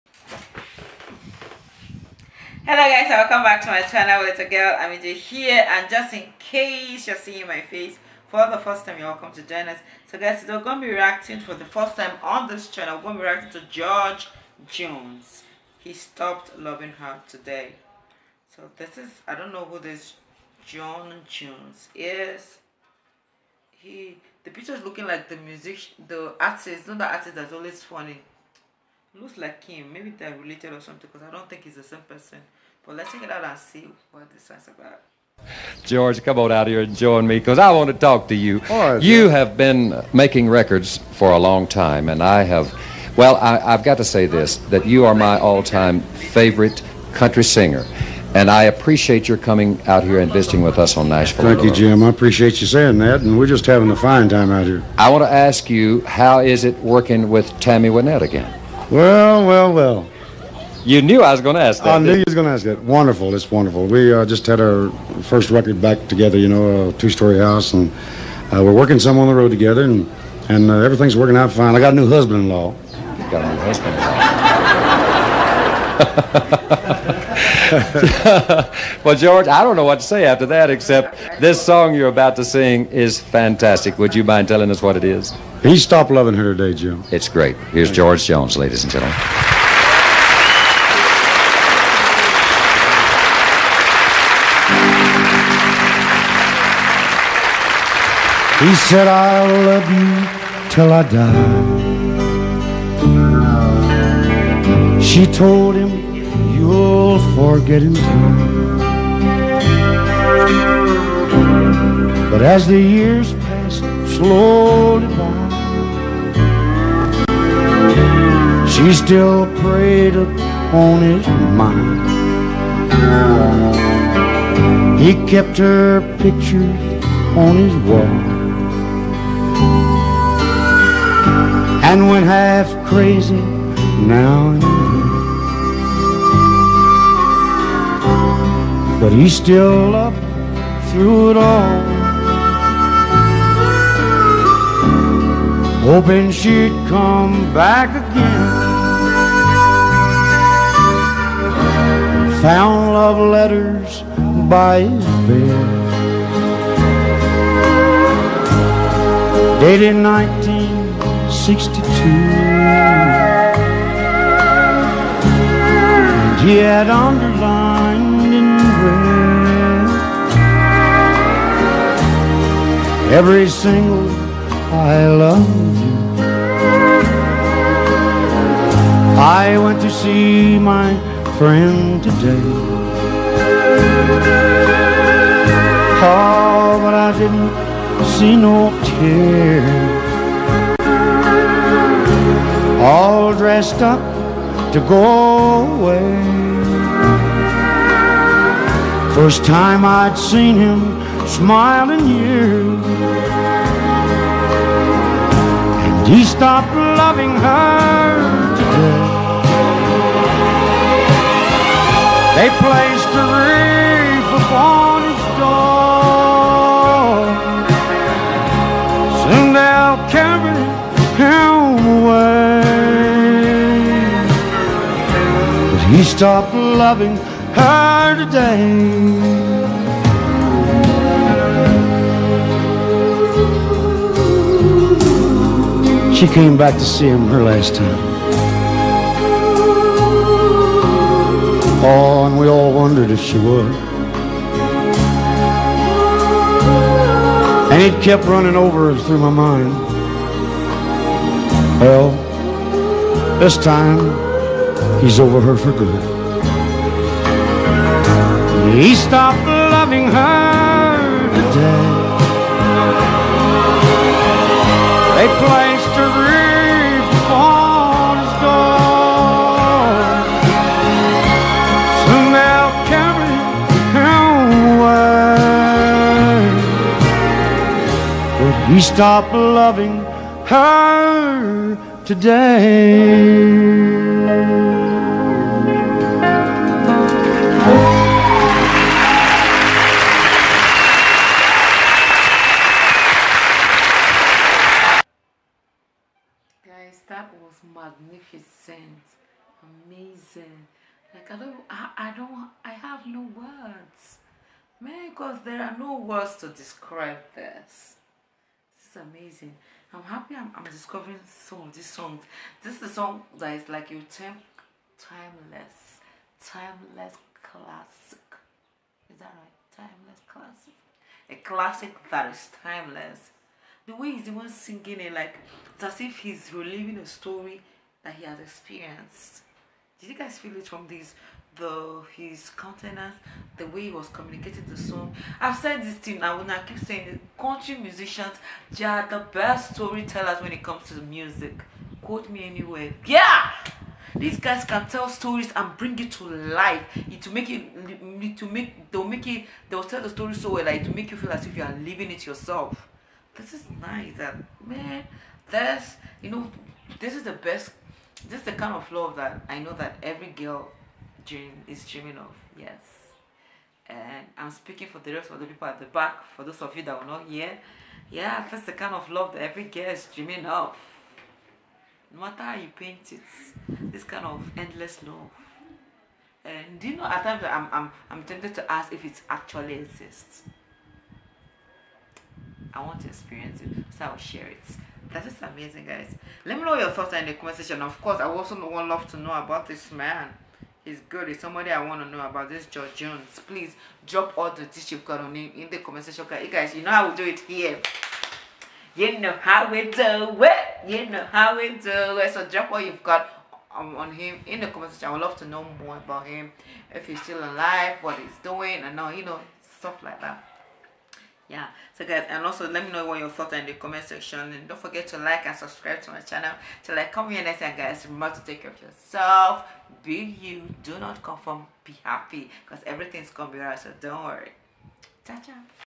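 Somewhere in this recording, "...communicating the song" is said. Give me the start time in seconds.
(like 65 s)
334 s.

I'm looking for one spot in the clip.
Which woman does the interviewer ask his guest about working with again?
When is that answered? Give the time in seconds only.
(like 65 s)
57 s.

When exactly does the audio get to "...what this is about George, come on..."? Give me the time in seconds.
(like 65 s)
34 s.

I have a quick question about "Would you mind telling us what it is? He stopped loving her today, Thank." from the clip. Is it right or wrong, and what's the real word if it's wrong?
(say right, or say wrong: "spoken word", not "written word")
wrong: "Jim", not "Thank".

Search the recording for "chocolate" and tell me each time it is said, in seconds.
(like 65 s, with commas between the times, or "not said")
not said.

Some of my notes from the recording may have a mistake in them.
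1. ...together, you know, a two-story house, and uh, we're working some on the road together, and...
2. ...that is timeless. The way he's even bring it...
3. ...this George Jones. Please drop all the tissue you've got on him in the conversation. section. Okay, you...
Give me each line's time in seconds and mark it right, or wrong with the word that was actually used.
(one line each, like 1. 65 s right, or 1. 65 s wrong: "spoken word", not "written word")
1. 66 s right
2. 322 s wrong: "singing", not "bring"
3. 392 s right.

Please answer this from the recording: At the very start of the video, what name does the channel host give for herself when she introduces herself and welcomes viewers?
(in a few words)
AmmyJ.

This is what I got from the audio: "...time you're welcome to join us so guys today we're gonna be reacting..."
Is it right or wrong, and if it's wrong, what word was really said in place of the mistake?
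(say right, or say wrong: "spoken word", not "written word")
right.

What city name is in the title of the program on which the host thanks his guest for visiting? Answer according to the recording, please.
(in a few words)
Nashville.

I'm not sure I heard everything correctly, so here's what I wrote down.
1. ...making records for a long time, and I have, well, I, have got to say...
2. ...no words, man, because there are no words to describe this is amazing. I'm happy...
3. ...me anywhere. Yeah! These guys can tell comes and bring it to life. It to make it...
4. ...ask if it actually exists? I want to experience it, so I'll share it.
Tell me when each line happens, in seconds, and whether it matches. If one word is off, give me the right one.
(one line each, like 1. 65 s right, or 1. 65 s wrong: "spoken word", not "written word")
1. 40 s right
2. 303 s right
3. 342 s wrong: "stories", not "comes"
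4. 378 s right.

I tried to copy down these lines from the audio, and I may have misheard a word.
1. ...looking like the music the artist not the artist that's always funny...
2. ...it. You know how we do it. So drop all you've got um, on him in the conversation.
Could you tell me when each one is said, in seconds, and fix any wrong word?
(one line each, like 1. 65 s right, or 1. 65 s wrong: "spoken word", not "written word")
1. 24 s right
2. 400 s right.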